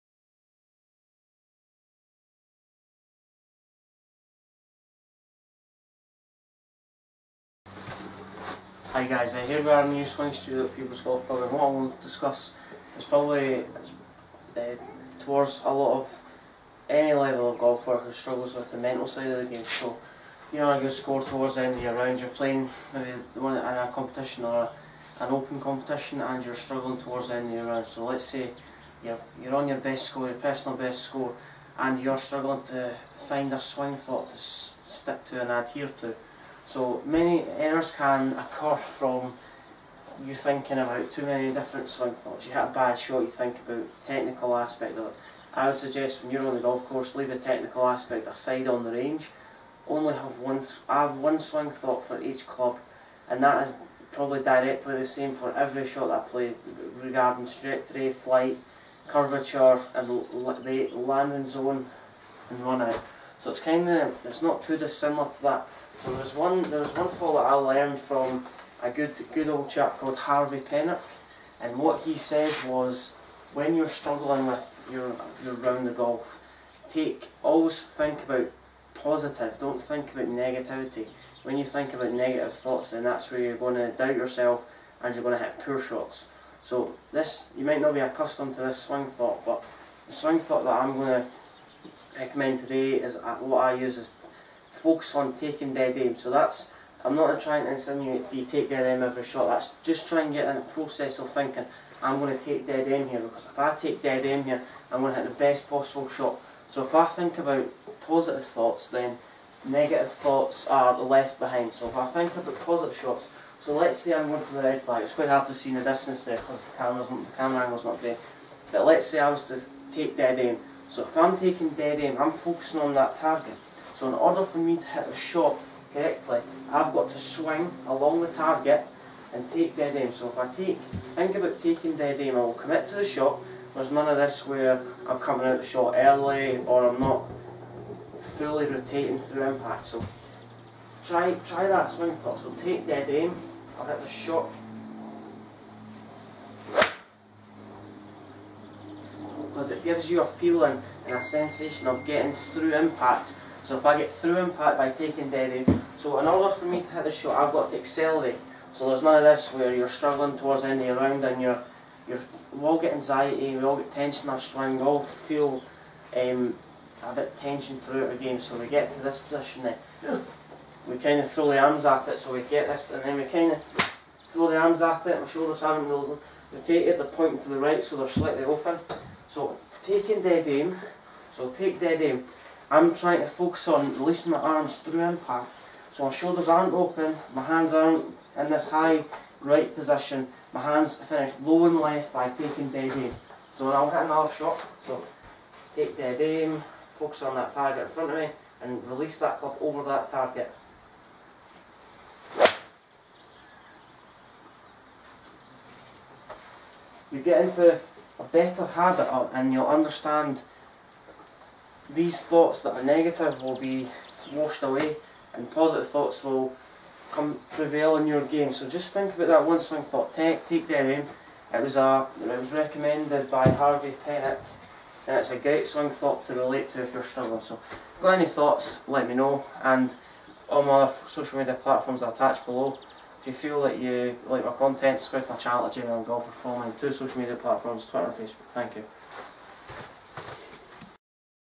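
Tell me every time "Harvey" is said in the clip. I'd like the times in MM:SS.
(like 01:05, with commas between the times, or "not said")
01:10, 03:43.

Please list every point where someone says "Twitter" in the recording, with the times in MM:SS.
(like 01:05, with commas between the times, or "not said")
03:57.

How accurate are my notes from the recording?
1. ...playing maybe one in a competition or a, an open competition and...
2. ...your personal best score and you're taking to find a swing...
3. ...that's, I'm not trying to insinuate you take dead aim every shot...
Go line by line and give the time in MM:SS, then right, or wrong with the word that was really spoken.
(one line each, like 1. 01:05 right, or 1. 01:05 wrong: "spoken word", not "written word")
1. 00:22 right
2. 00:30 wrong: "struggling", not "taking"
3. 01:36 right.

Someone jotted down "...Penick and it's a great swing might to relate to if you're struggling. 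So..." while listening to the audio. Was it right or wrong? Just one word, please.
wrong.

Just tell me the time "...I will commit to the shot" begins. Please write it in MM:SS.
02:12.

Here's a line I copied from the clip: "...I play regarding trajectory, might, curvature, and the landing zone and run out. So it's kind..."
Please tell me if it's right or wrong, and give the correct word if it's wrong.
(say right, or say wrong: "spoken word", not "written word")
wrong: "flight", not "might".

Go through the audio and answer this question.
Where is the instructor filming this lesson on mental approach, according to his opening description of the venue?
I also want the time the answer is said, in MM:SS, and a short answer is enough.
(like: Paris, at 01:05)
New Swing Studio, at 00:09.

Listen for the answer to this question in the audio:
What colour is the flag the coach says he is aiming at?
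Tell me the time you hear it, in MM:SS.
01:54.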